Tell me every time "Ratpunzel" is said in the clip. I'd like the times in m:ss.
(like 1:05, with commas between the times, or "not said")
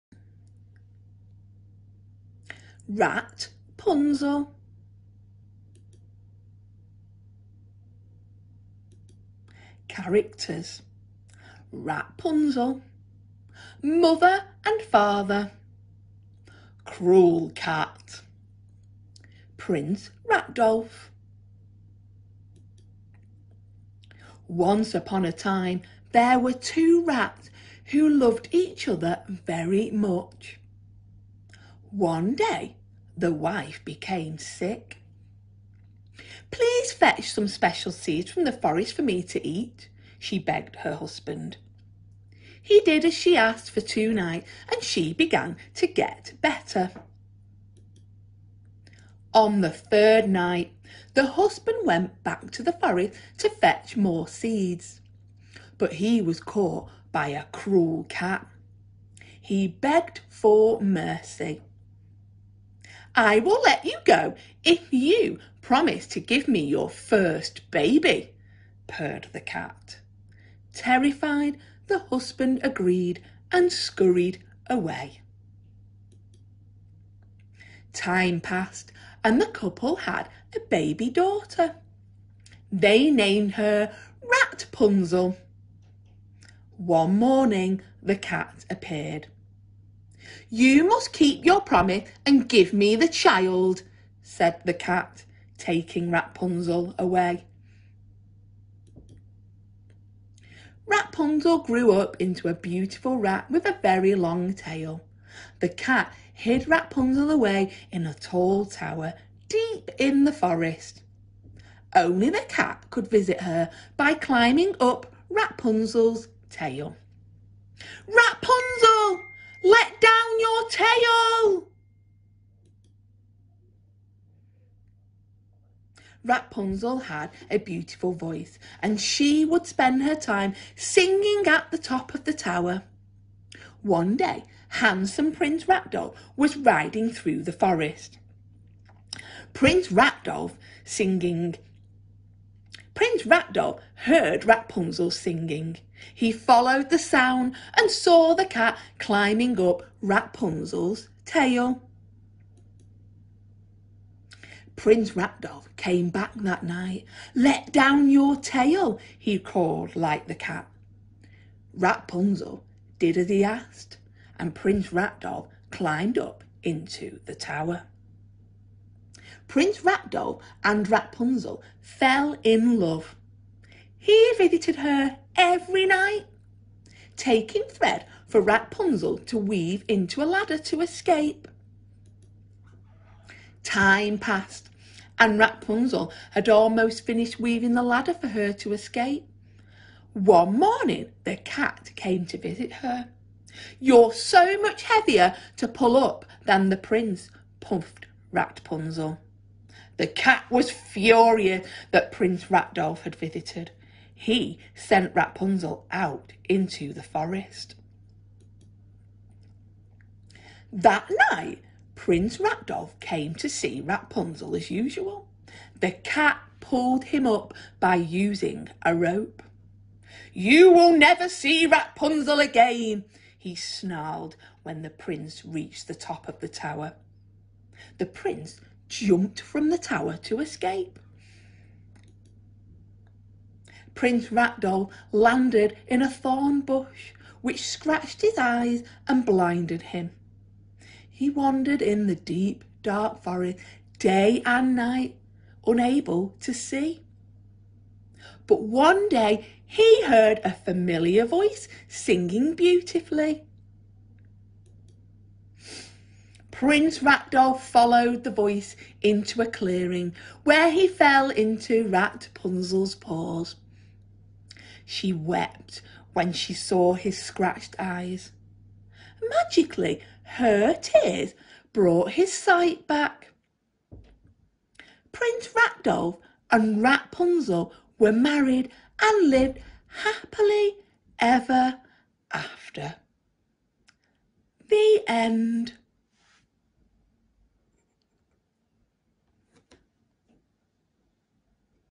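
1:24, 4:21.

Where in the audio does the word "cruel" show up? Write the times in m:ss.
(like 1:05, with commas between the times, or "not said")
0:16, 0:57.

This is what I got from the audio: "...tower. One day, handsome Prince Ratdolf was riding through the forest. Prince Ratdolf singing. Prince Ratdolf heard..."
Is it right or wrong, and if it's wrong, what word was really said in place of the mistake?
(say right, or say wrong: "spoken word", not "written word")
right.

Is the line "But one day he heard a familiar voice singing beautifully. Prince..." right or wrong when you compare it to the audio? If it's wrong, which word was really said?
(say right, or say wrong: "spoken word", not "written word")
right.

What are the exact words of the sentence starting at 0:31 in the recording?
One day the wife became sick.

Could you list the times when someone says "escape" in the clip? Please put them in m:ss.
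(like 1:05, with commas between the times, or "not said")
3:00, 3:08, 3:50.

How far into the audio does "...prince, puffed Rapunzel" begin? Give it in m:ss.
3:16.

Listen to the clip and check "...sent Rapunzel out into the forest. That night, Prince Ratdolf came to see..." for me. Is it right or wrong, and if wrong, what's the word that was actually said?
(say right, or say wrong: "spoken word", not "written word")
right.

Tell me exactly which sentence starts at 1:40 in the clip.
Rapunzel grew up into a beautiful rat with a very long tail.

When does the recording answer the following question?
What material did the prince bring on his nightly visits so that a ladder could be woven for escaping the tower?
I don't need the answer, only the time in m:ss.
2:57.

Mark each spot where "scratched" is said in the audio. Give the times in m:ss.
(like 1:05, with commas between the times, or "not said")
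3:57, 4:27.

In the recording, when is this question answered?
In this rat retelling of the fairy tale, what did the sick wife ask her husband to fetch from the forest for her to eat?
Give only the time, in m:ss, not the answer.
0:37.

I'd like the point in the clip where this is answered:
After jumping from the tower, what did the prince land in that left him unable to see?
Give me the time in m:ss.
3:56.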